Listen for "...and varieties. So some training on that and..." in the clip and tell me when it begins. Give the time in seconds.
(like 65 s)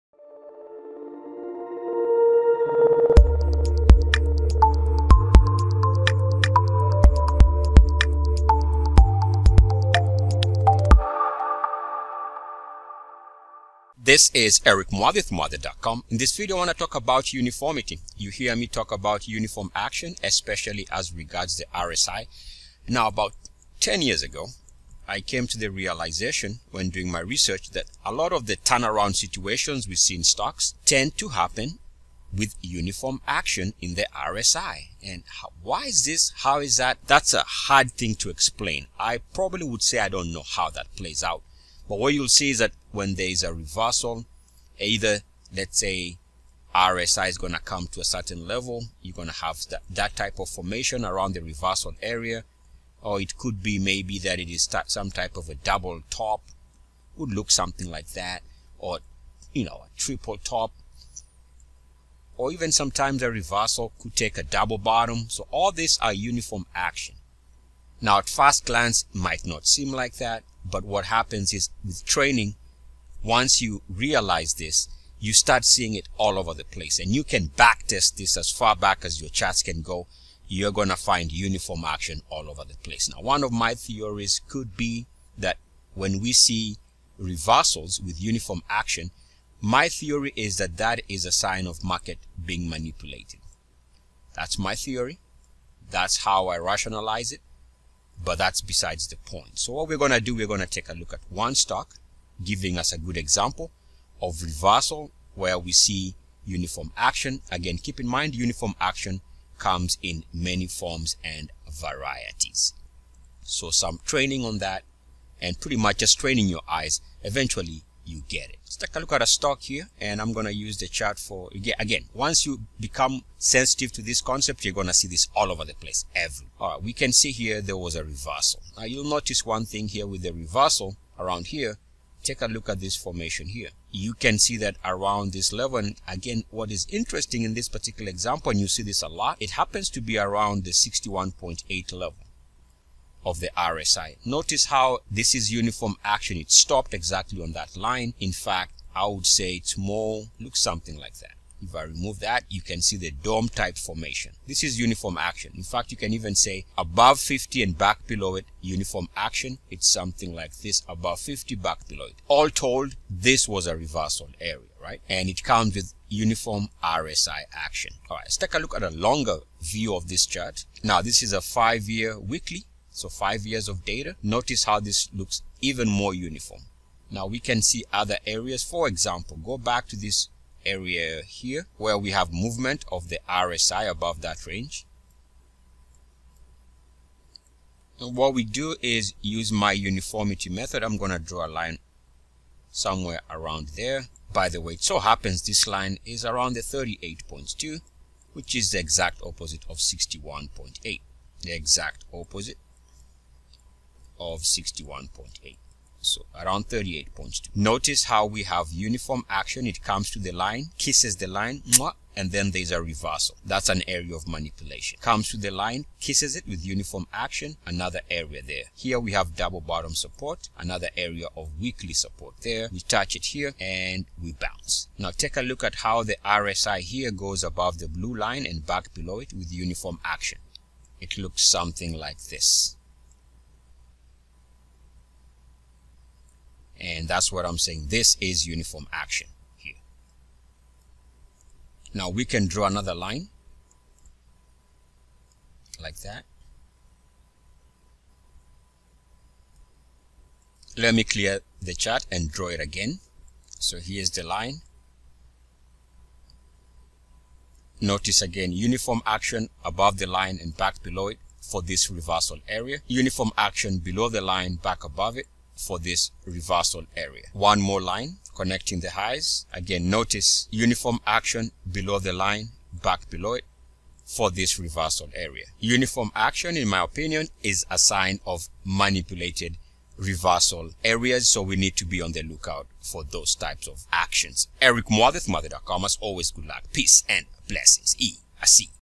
111 s.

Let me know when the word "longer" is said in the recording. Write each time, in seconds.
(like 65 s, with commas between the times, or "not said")
168 s.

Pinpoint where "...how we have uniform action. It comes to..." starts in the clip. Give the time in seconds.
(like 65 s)
208 s.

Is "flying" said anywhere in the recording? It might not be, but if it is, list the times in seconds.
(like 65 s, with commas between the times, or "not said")
not said.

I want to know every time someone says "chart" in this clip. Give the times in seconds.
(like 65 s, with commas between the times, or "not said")
79 s, 120 s, 170 s, 251 s.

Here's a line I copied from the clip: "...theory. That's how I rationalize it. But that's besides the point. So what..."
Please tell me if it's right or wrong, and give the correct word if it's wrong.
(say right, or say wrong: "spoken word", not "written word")
right.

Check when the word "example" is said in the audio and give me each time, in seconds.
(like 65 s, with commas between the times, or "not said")
103 s, 138 s, 178 s.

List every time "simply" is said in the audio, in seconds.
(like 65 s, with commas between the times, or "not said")
not said.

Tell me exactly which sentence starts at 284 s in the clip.
Eric Muathe, Muathe.com, as always, good luck, peace, and blessings.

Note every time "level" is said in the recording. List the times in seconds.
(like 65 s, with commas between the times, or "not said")
48 s, 135 s, 141 s.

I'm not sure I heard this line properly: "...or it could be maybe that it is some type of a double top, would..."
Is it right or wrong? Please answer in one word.
right.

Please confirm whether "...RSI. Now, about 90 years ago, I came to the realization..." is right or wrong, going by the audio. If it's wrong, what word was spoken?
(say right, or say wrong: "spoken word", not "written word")
wrong: "10", not "90".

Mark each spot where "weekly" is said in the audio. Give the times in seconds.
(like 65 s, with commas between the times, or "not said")
172 s, 221 s.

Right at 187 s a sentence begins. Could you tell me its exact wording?
And what we do is use my uniformity method.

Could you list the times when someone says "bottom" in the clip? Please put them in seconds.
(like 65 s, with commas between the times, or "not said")
64 s, 219 s.